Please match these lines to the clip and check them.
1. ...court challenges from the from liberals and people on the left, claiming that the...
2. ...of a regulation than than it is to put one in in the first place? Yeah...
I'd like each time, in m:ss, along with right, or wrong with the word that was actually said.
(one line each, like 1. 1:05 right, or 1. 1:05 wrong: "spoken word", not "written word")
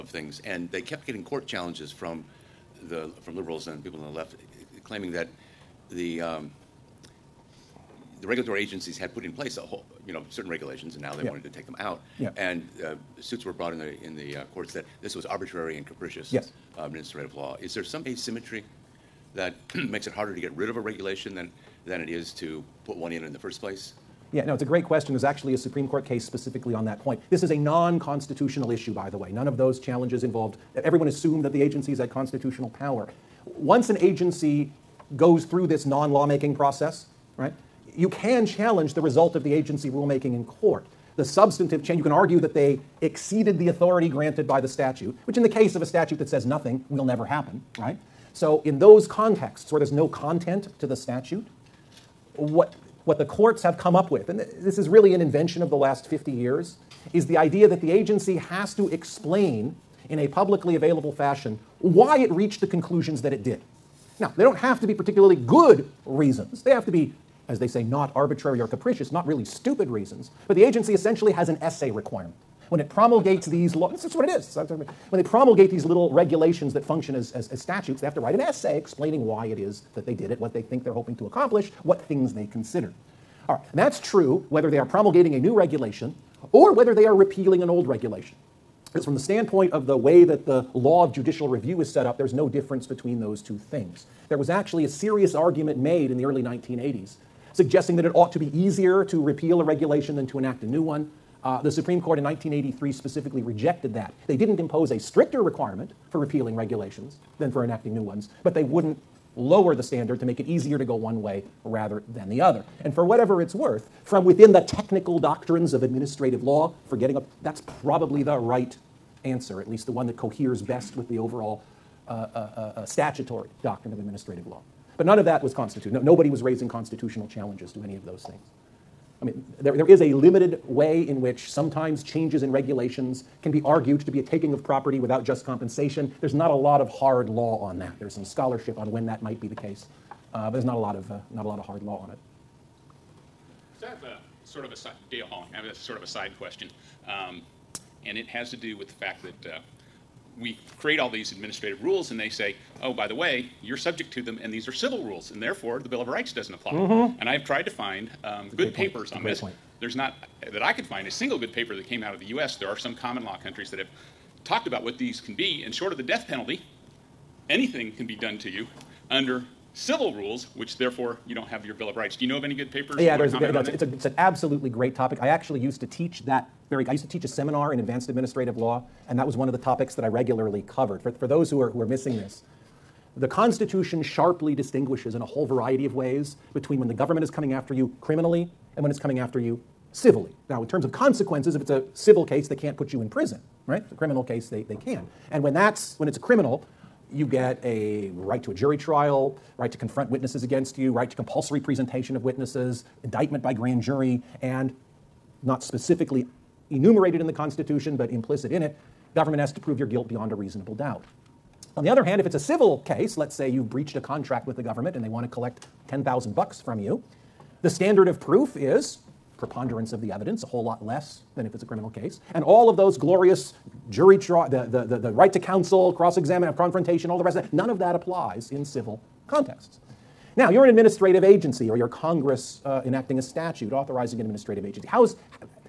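1. 0:01 right
2. 0:20 right.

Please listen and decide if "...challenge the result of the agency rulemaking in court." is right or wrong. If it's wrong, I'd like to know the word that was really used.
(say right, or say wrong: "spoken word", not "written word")
right.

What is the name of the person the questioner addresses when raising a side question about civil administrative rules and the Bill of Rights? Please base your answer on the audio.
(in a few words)
Dale Halling.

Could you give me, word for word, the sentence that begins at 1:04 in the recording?
Now, they don't have to be particularly good reasons.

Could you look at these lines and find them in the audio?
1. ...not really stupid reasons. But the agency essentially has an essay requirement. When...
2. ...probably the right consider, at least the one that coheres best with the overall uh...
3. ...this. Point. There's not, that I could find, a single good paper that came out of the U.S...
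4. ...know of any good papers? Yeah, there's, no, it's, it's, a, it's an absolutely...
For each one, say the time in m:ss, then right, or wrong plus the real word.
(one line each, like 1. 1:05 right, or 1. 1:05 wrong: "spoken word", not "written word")
1. 1:09 right
2. 1:57 wrong: "answer", not "consider"
3. 2:39 right
4. 2:52 right.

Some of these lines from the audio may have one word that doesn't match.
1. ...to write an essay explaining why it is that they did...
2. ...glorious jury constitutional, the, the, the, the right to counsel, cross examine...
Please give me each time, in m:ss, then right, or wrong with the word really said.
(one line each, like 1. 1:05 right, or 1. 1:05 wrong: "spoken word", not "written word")
1. 1:18 right
2. 3:42 wrong: "trial", not "constitutional".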